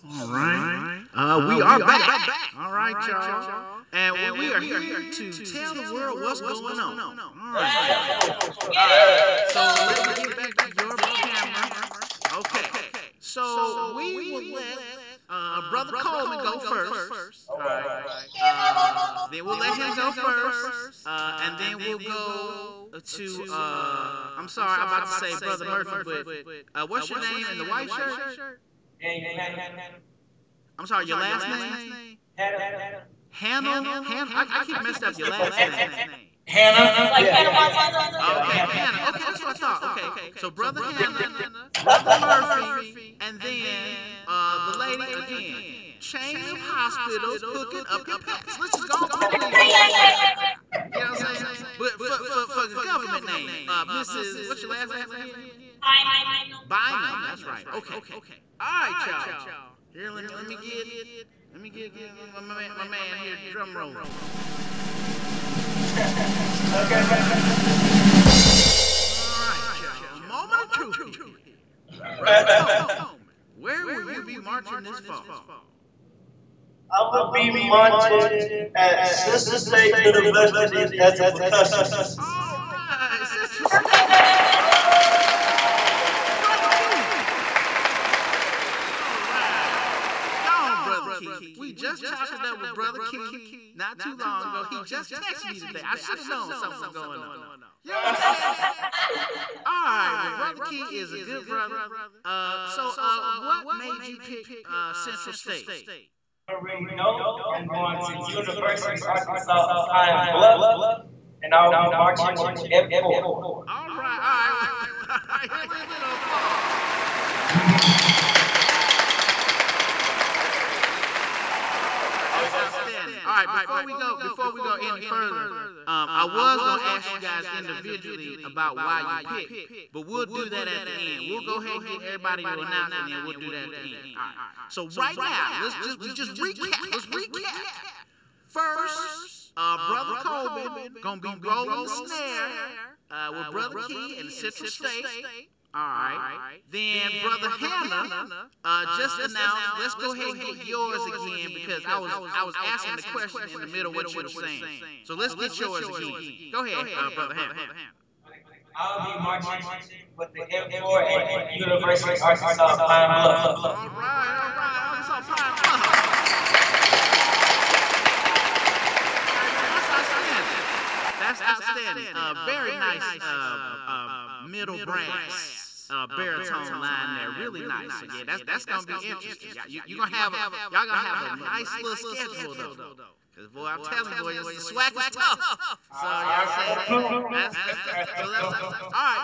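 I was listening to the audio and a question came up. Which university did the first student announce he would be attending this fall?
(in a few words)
Central State University.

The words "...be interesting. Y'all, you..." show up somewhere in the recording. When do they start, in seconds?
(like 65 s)
178 s.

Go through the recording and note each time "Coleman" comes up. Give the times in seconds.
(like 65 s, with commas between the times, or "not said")
15 s, 72 s.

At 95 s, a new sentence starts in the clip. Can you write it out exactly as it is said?
I should have known something was going on.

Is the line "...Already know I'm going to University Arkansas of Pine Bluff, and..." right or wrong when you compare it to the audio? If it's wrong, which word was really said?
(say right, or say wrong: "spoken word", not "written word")
right.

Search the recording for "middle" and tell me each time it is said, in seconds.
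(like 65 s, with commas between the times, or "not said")
153 s, 174 s.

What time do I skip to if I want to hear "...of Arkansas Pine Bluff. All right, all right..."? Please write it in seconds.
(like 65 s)
162 s.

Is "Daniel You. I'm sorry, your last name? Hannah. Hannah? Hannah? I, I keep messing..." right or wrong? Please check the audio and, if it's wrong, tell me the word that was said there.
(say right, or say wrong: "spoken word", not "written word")
wrong: "Hannah", not "You".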